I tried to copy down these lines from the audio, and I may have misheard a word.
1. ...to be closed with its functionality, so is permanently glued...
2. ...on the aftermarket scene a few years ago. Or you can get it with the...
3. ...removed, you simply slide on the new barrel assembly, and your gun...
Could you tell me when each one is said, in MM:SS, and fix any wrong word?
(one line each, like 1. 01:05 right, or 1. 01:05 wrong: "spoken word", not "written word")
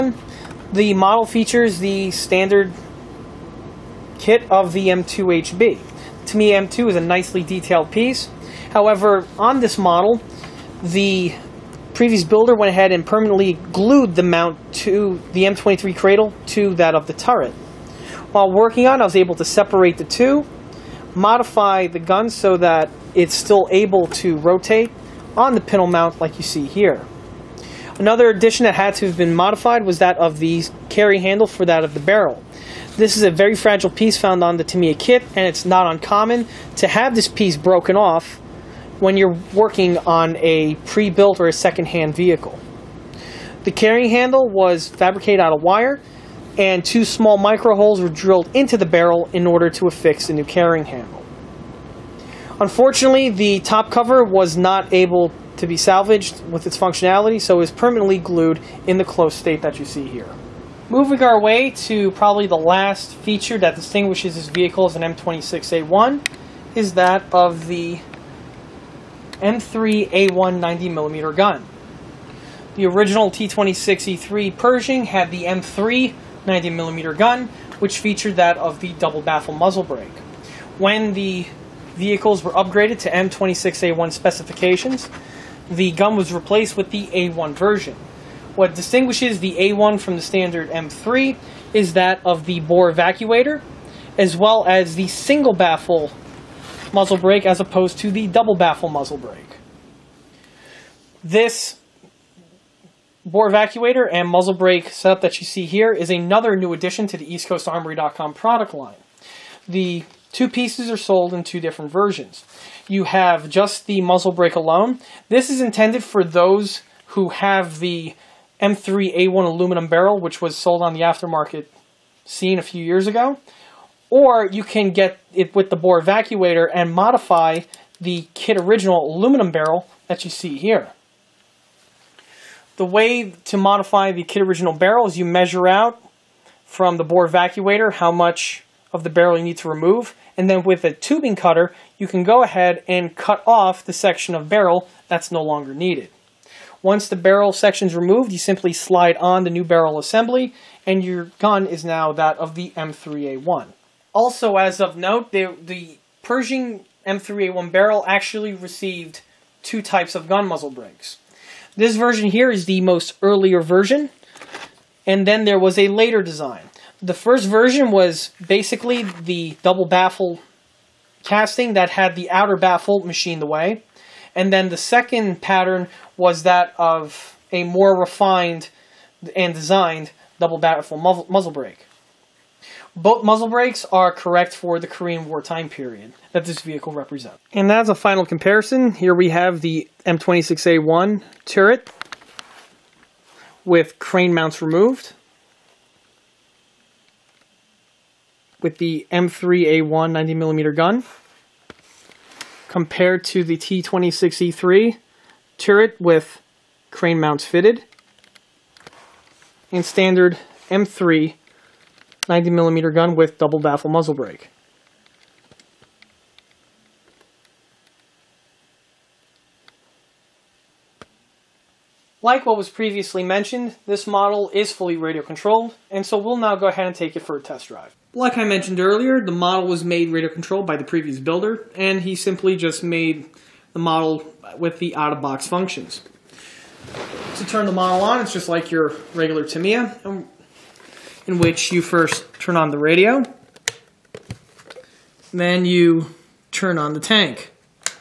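1. 00:55 wrong: "salvaged", not "closed"
2. 02:00 right
3. 02:27 right.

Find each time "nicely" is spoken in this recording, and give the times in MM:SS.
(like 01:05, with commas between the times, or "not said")
00:07.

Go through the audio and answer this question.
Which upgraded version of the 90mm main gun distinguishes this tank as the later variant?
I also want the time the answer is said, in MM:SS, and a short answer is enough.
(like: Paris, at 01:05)
M3A1, at 01:09.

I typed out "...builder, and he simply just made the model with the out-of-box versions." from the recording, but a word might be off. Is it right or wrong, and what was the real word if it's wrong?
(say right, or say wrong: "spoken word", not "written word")
wrong: "functions", not "versions".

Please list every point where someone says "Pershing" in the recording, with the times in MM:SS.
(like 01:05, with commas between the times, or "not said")
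01:14, 02:36.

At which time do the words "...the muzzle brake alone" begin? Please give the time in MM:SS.
01:53.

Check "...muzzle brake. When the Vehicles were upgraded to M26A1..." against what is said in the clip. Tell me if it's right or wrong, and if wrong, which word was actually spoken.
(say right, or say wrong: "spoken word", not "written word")
right.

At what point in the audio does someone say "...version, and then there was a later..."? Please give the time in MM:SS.
02:43.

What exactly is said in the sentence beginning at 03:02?
Both muzzle brakes are correct for the Korean War time period that this vehicle represents.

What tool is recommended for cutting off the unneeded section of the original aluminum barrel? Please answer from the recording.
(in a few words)
Tubing cutter.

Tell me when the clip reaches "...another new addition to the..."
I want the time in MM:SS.
01:46.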